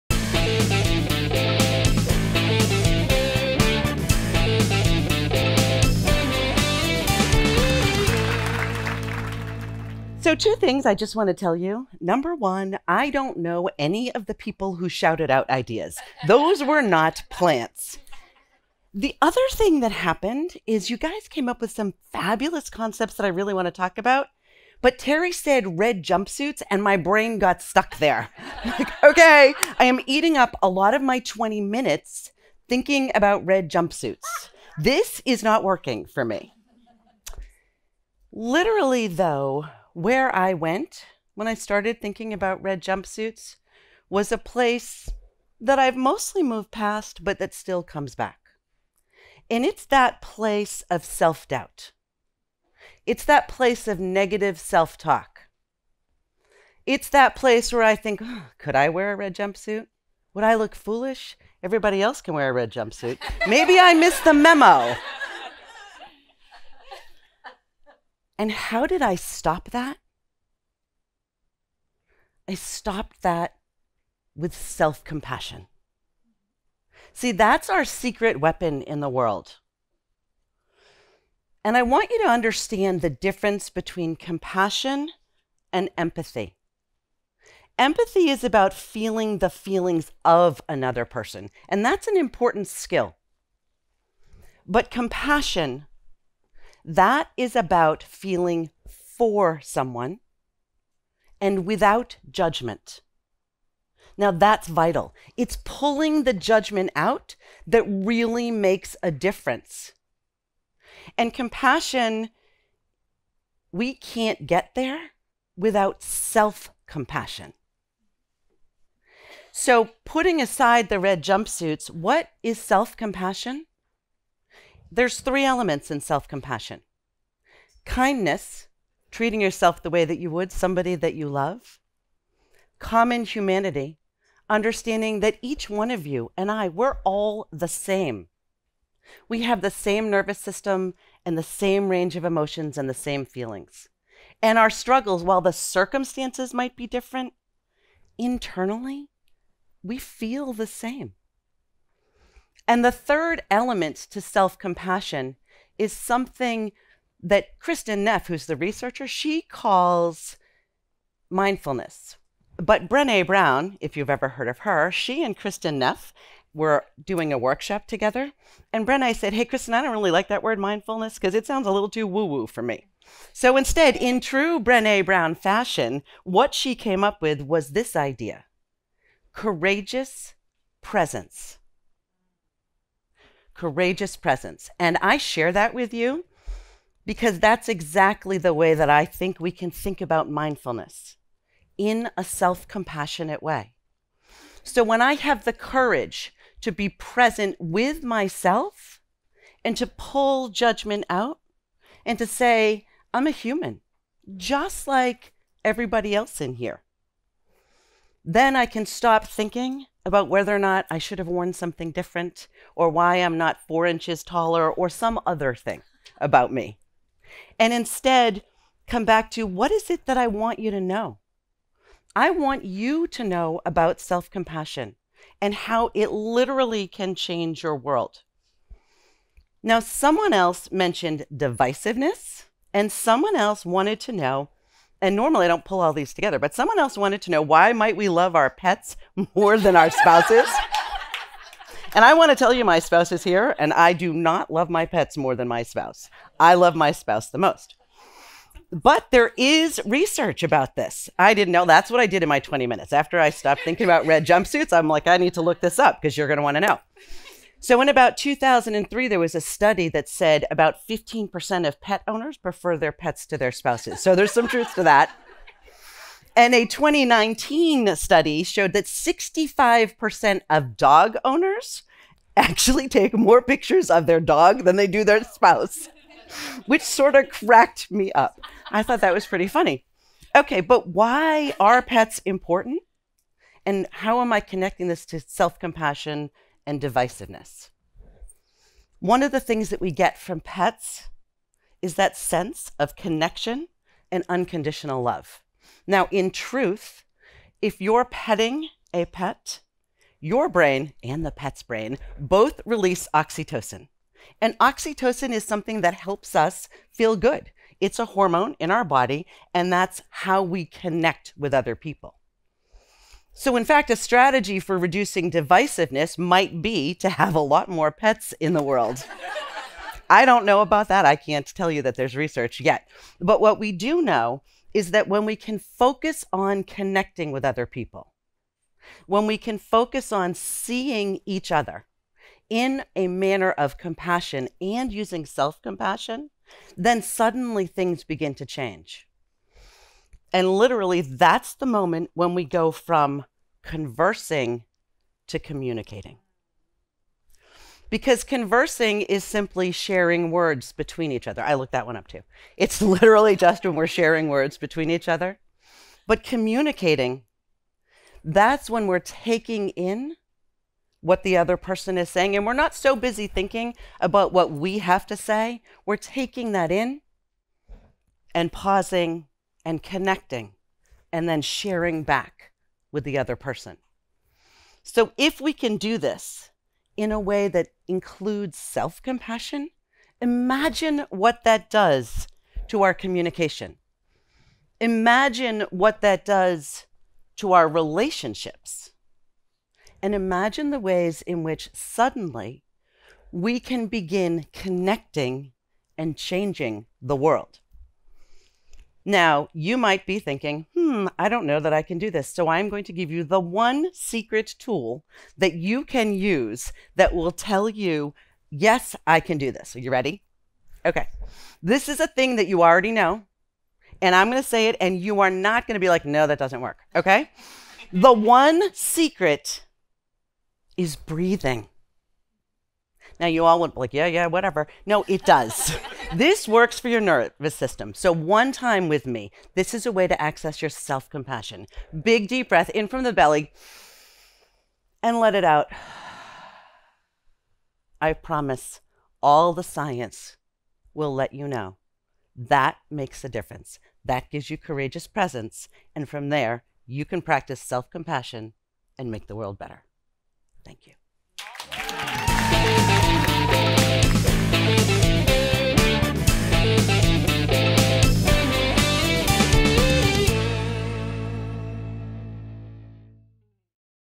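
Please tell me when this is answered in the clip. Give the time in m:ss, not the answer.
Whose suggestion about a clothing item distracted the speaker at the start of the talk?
0:24.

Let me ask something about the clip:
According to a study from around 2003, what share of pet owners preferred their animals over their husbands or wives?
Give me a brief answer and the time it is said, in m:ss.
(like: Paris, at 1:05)
15%, at 4:20.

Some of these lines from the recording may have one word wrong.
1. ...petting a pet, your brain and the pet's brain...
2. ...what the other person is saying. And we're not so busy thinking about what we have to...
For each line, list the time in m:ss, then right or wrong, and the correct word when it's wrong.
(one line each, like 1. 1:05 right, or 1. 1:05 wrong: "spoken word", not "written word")
1. 4:58 right
2. 6:01 right.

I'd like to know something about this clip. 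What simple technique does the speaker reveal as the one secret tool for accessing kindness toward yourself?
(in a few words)
breathing.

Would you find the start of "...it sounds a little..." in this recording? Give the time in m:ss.
2:51.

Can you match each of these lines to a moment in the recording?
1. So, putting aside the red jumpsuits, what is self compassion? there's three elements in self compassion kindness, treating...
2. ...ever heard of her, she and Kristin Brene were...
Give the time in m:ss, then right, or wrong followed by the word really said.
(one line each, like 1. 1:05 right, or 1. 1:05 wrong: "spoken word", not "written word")
1. 1:59 right
2. 2:44 wrong: "Neff", not "Brene".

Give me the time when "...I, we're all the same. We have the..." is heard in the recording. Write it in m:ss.
2:16.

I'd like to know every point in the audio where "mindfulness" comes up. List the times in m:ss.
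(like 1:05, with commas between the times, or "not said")
2:41, 2:50, 3:10.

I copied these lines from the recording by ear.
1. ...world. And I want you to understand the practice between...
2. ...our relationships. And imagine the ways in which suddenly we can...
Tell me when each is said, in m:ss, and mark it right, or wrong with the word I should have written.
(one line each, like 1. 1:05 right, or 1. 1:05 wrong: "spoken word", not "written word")
1. 1:19 wrong: "difference", not "practice"
2. 6:27 right.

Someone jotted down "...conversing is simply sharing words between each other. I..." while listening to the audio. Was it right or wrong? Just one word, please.
right.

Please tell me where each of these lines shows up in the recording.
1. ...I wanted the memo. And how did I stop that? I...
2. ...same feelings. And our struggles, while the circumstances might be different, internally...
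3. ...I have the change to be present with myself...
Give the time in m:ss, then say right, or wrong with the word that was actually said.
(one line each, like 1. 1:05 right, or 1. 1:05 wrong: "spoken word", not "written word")
1. 1:03 wrong: "missed", not "wanted"
2. 2:22 right
3. 3:14 wrong: "courage", not "change".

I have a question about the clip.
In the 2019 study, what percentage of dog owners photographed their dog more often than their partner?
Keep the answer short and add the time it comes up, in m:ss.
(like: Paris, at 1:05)
65%, at 4:28.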